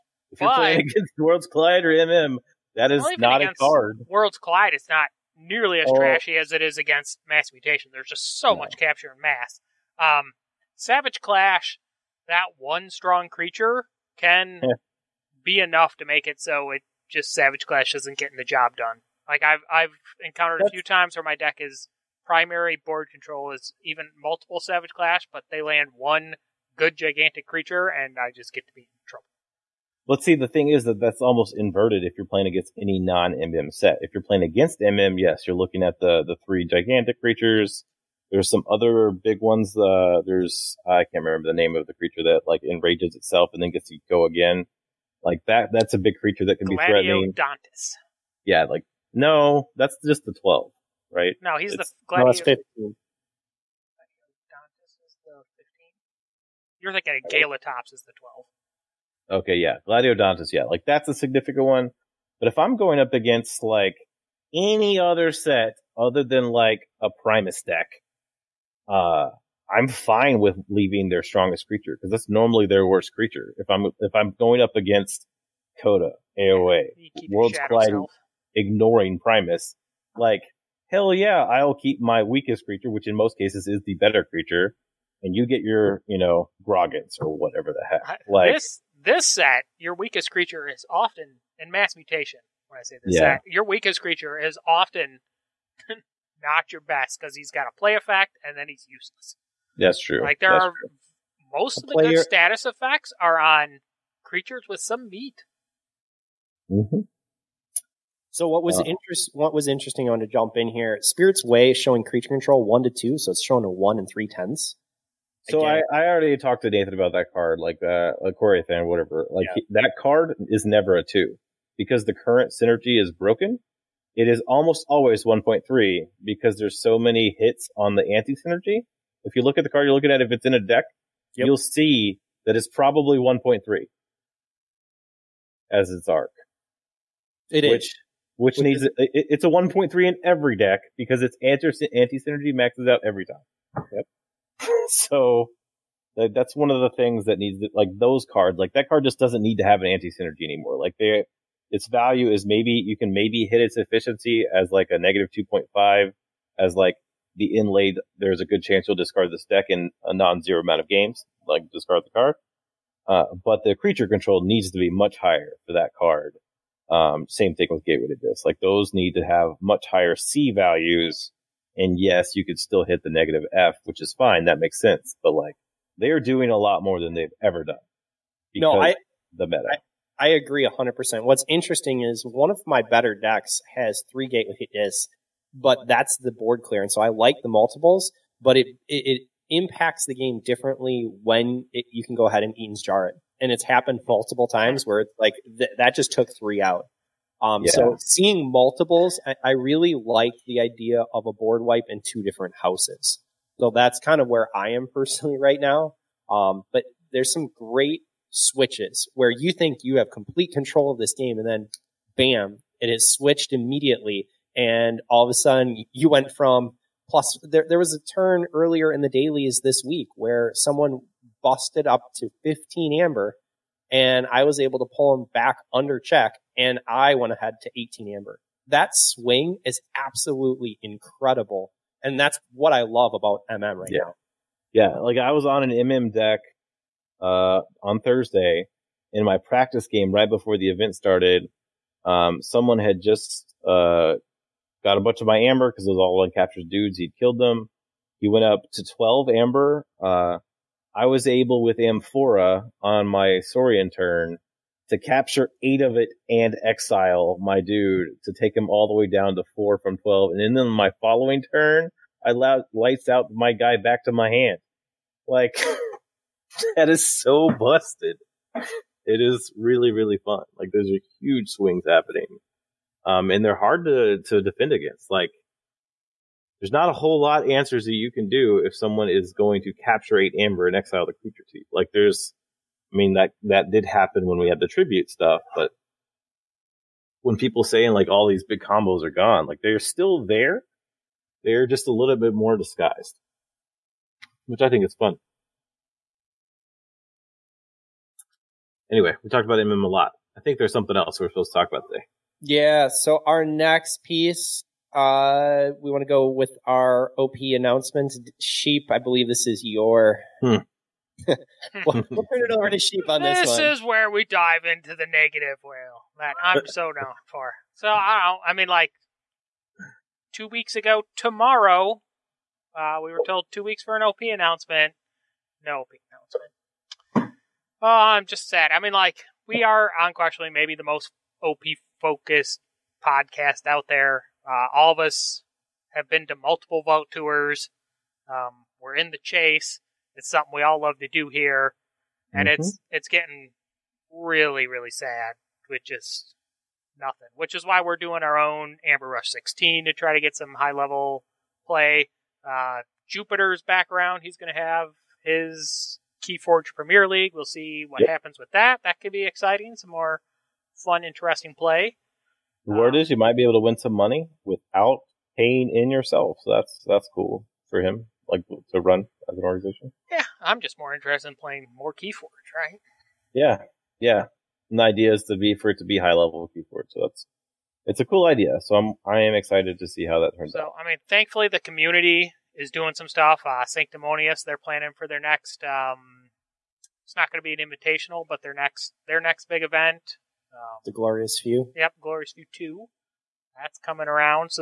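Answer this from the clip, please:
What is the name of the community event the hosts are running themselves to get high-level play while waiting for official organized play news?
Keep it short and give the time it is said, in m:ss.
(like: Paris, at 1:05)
Amber Rush 16, at 5:48.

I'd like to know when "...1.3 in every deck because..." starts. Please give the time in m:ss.
2:19.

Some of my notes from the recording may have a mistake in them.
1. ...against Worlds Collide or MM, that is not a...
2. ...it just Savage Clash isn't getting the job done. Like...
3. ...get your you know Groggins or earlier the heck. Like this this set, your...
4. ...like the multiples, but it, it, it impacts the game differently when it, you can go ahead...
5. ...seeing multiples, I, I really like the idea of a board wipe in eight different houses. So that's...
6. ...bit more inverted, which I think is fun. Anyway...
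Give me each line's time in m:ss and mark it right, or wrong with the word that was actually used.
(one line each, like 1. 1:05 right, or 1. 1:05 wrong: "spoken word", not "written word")
1. 0:00 right
2. 0:16 right
3. 1:25 wrong: "whatever", not "earlier"
4. 3:07 right
5. 3:17 wrong: "two", not "eight"
6. 4:52 wrong: "disguised", not "inverted".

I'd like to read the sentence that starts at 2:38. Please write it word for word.
There's a good chance you'll discard this deck in a non-zero amount of games, like discard the card.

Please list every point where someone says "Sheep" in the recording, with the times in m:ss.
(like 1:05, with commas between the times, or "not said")
5:08, 5:12.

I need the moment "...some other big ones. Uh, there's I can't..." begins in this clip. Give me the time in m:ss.
0:38.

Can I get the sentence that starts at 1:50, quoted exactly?
Spirit's Way showing creature control one to two, so it's showing a one and three tenths.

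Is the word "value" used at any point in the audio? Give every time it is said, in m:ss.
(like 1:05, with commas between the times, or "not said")
2:31, 2:50.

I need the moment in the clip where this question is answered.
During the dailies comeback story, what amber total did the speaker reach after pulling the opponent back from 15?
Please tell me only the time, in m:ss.
3:47.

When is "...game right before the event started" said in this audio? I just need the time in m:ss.
3:59.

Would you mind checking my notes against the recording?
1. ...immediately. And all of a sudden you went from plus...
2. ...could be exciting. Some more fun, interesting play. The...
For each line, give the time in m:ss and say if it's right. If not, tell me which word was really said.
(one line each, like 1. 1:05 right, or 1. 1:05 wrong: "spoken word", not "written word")
1. 3:33 right
2. 5:58 right.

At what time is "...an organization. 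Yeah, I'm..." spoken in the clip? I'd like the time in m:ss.
6:09.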